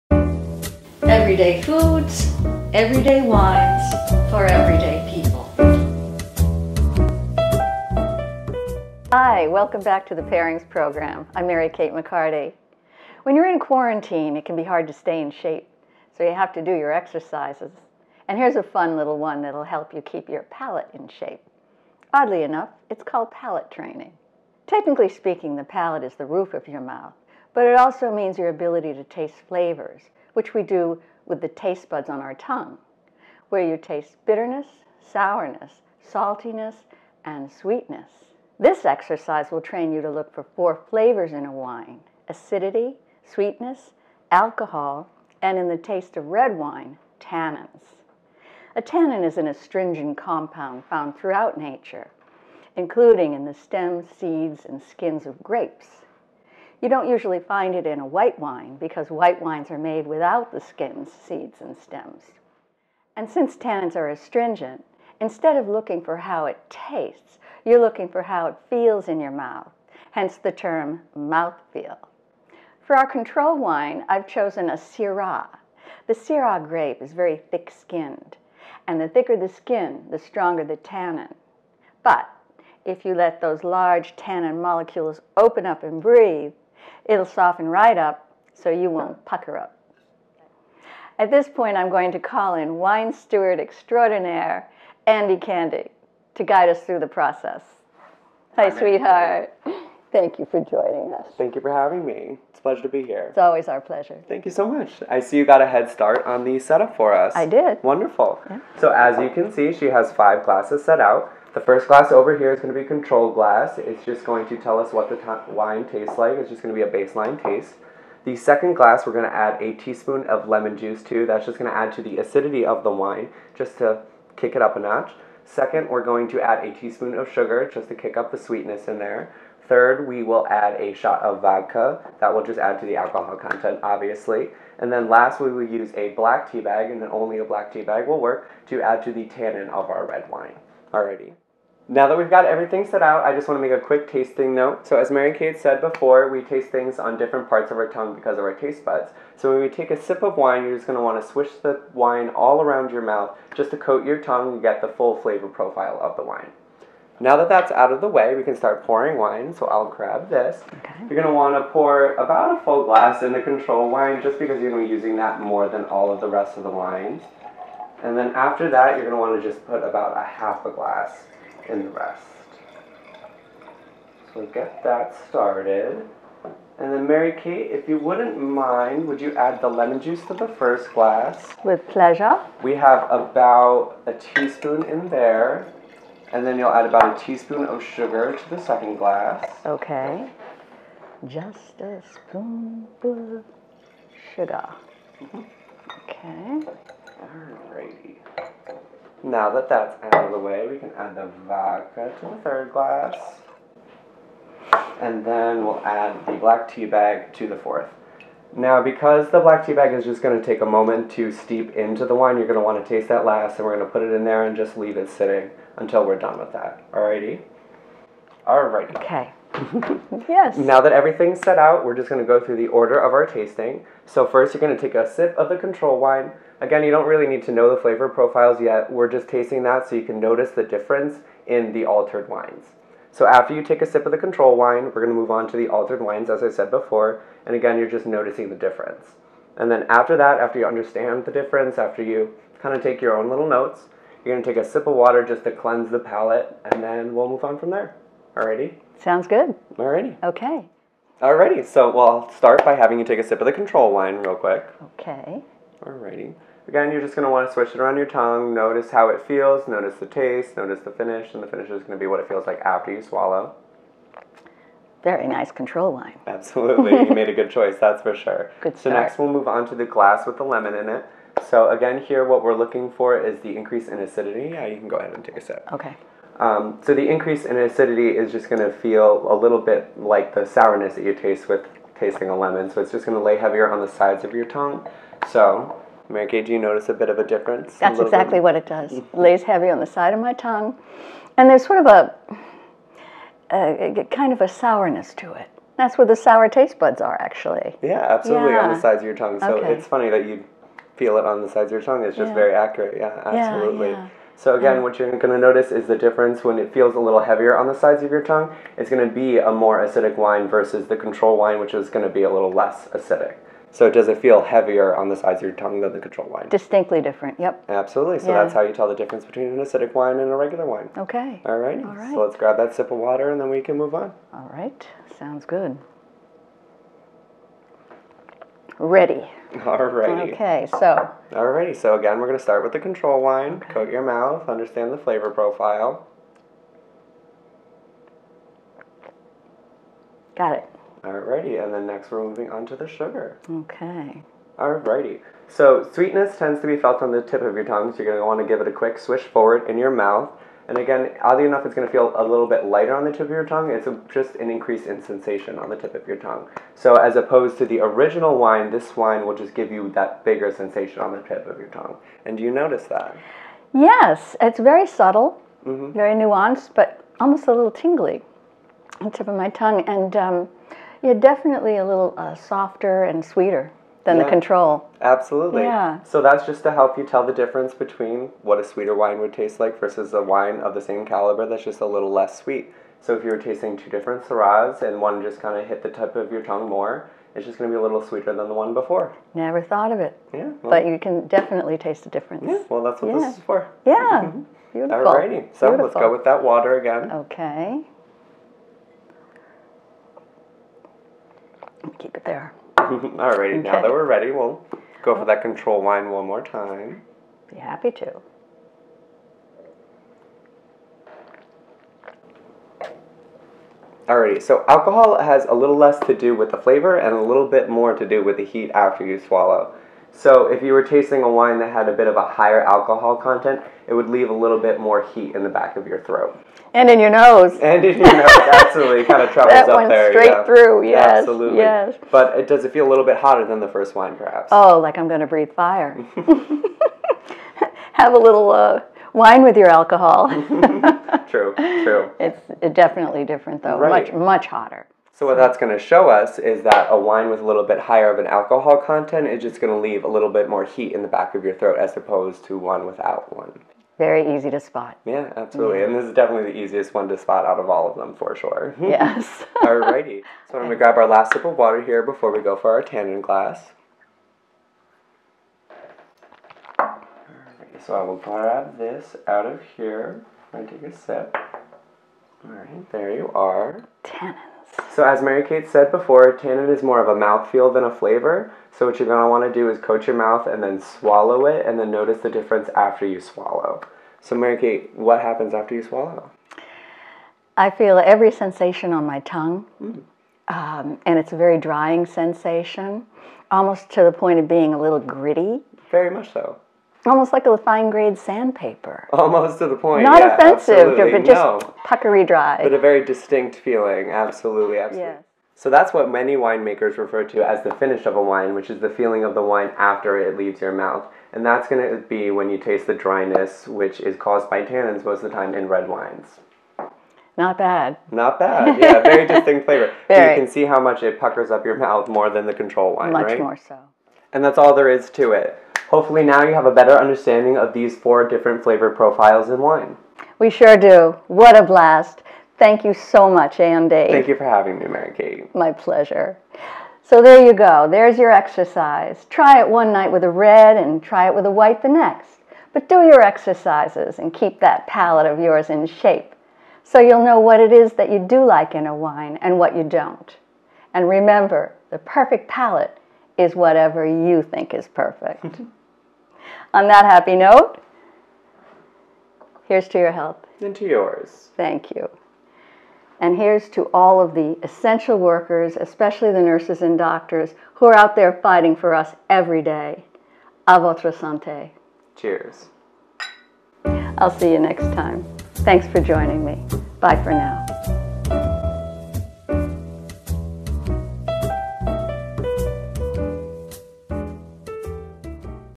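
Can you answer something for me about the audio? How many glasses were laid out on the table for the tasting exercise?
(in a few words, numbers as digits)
5.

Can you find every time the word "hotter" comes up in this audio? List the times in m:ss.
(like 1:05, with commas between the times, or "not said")
7:13, 7:24.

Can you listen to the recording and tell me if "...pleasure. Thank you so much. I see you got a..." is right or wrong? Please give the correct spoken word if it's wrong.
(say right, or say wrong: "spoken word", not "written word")
right.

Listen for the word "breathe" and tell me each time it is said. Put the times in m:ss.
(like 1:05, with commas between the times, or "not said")
1:26, 7:15.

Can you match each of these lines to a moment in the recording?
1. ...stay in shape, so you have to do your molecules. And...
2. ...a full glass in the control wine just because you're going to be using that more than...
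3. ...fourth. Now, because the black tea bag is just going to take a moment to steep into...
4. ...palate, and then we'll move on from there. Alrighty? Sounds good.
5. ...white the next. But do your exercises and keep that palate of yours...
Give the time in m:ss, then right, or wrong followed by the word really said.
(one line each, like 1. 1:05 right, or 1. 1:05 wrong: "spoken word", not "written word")
1. 0:14 wrong: "exercises", not "molecules"
2. 2:42 right
3. 3:27 right
4. 4:05 right
5. 9:01 right.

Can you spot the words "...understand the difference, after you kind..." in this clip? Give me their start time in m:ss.
4:00.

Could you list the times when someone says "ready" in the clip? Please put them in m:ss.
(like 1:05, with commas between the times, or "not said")
5:28, 6:44.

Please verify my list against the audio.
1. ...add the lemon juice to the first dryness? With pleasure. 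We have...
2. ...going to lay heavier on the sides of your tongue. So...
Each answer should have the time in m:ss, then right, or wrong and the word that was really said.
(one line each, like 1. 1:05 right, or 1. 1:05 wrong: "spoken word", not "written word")
1. 2:59 wrong: "glass", not "dryness"
2. 4:43 right.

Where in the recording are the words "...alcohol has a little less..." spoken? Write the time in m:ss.
6:54.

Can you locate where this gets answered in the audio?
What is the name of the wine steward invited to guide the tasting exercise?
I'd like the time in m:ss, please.
1:35.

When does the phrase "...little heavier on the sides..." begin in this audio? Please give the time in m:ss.
5:06.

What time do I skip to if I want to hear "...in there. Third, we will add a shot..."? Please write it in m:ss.
2:08.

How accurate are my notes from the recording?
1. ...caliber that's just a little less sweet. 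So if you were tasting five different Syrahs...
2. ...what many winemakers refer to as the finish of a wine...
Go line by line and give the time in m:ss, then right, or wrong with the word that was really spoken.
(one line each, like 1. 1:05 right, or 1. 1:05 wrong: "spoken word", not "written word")
1. 6:21 wrong: "two", not "five"
2. 8:25 right.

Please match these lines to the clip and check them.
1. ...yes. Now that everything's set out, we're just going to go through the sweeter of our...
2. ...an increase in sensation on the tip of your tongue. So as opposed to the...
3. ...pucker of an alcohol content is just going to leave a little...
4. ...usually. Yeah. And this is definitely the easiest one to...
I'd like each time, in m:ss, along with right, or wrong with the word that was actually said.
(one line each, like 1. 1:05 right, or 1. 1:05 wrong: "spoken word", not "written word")
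1. 3:40 wrong: "order", not "sweeter"
2. 5:54 right
3. 7:27 wrong: "higher", not "pucker"
4. 7:35 wrong: "absolutely", not "usually".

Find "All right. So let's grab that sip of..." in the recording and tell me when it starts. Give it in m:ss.
5:21.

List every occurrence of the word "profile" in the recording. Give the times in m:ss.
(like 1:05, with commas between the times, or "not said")
2:35, 3:48, 5:35, 8:48.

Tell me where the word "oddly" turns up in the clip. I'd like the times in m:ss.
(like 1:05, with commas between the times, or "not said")
0:22, 5:51.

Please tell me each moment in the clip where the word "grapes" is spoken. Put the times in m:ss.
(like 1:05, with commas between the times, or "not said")
0:55, 1:16.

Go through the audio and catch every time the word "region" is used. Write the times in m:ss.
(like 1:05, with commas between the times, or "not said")
not said.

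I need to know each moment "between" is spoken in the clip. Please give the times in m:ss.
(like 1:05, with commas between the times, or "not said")
5:19, 6:17.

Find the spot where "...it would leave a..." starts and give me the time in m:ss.
7:03.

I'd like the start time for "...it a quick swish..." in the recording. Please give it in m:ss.
5:48.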